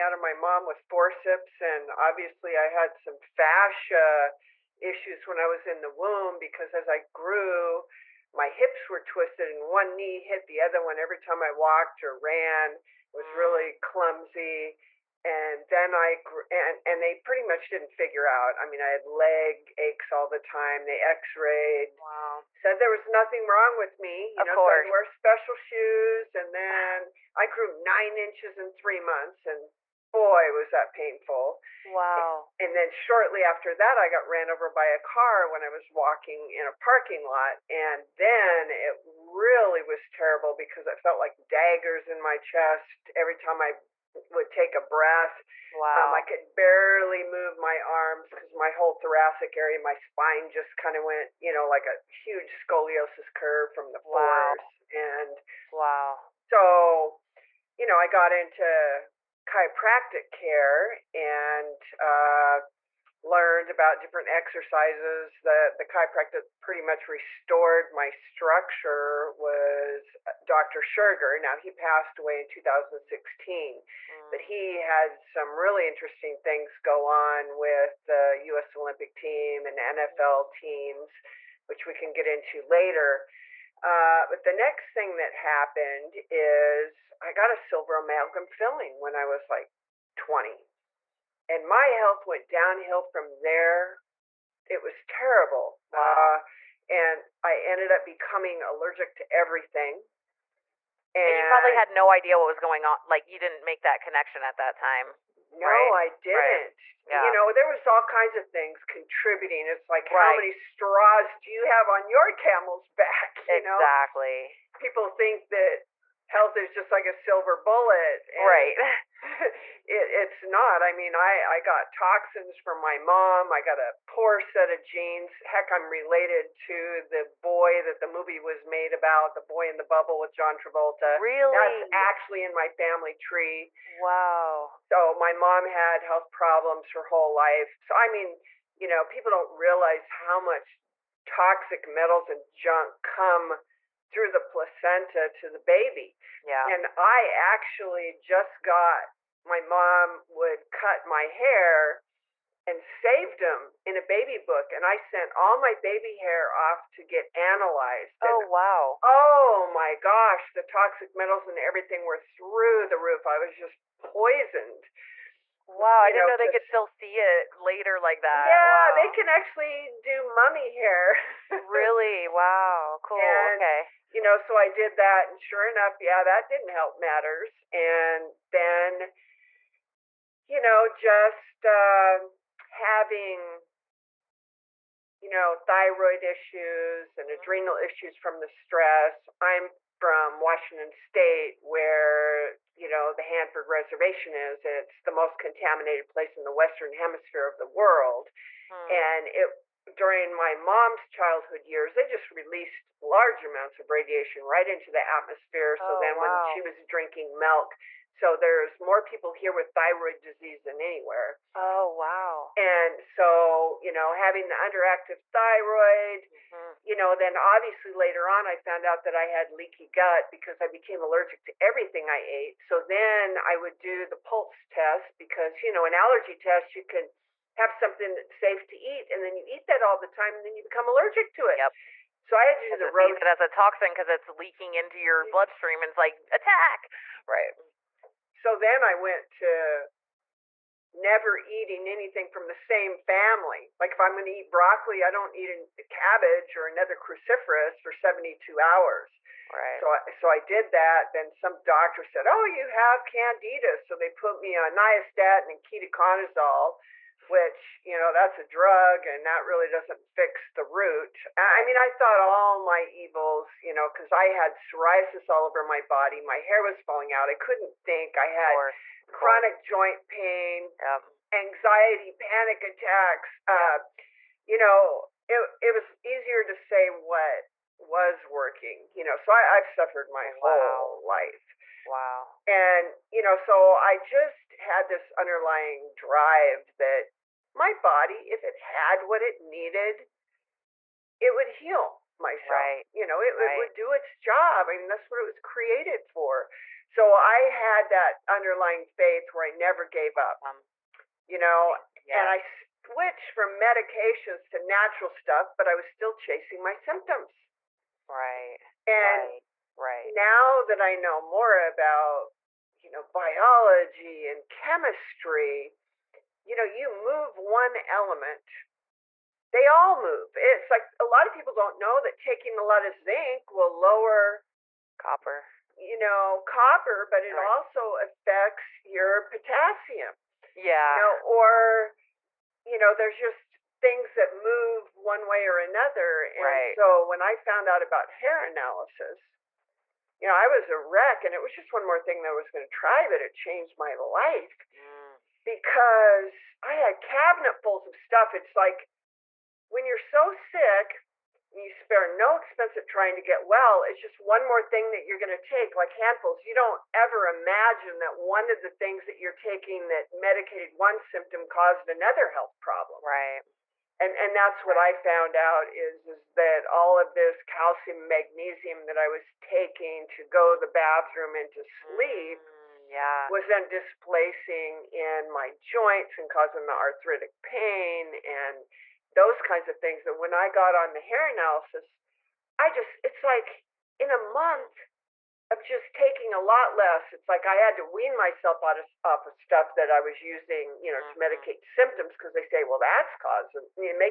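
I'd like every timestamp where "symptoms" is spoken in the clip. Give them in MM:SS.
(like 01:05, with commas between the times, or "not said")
05:06, 06:00, 06:31.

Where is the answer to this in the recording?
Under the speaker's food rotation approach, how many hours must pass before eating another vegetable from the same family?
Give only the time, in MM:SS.
04:07.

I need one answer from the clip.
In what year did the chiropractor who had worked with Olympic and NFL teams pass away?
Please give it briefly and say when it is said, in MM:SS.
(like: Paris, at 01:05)
2016, at 01:12.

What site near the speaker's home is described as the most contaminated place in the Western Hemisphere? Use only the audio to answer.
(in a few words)
Hanford Reservation.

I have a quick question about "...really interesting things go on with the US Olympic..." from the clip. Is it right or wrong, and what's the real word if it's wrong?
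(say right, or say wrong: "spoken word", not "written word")
right.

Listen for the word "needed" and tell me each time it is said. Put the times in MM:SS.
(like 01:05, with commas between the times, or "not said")
04:49.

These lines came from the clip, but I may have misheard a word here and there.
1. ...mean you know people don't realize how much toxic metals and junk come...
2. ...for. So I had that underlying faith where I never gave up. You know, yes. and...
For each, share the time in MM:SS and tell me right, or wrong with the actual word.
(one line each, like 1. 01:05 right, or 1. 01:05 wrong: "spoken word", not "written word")
1. 02:18 right
2. 04:56 right.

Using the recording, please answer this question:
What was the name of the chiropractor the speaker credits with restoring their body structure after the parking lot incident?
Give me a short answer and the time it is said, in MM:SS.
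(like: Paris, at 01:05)
Dr. Scherger, at 01:10.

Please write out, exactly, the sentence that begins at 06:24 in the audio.
month I'm just taking a lot less.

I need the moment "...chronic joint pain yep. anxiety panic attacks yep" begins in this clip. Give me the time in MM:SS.
04:29.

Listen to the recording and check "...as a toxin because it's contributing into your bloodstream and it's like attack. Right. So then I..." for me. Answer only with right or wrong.
wrong.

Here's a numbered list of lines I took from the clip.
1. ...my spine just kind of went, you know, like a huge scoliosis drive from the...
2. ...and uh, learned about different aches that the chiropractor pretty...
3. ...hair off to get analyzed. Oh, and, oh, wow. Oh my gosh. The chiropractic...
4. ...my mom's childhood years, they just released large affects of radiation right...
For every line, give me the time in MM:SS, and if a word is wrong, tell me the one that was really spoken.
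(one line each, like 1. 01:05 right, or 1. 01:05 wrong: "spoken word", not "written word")
1. 00:49 wrong: "curve", not "drive"
2. 01:01 wrong: "exercises", not "aches"
3. 02:36 wrong: "toxic", not "chiropractic"
4. 03:20 wrong: "amounts", not "affects".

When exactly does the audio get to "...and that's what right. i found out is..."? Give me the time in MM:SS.
06:04.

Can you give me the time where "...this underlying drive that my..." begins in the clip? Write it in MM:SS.
04:44.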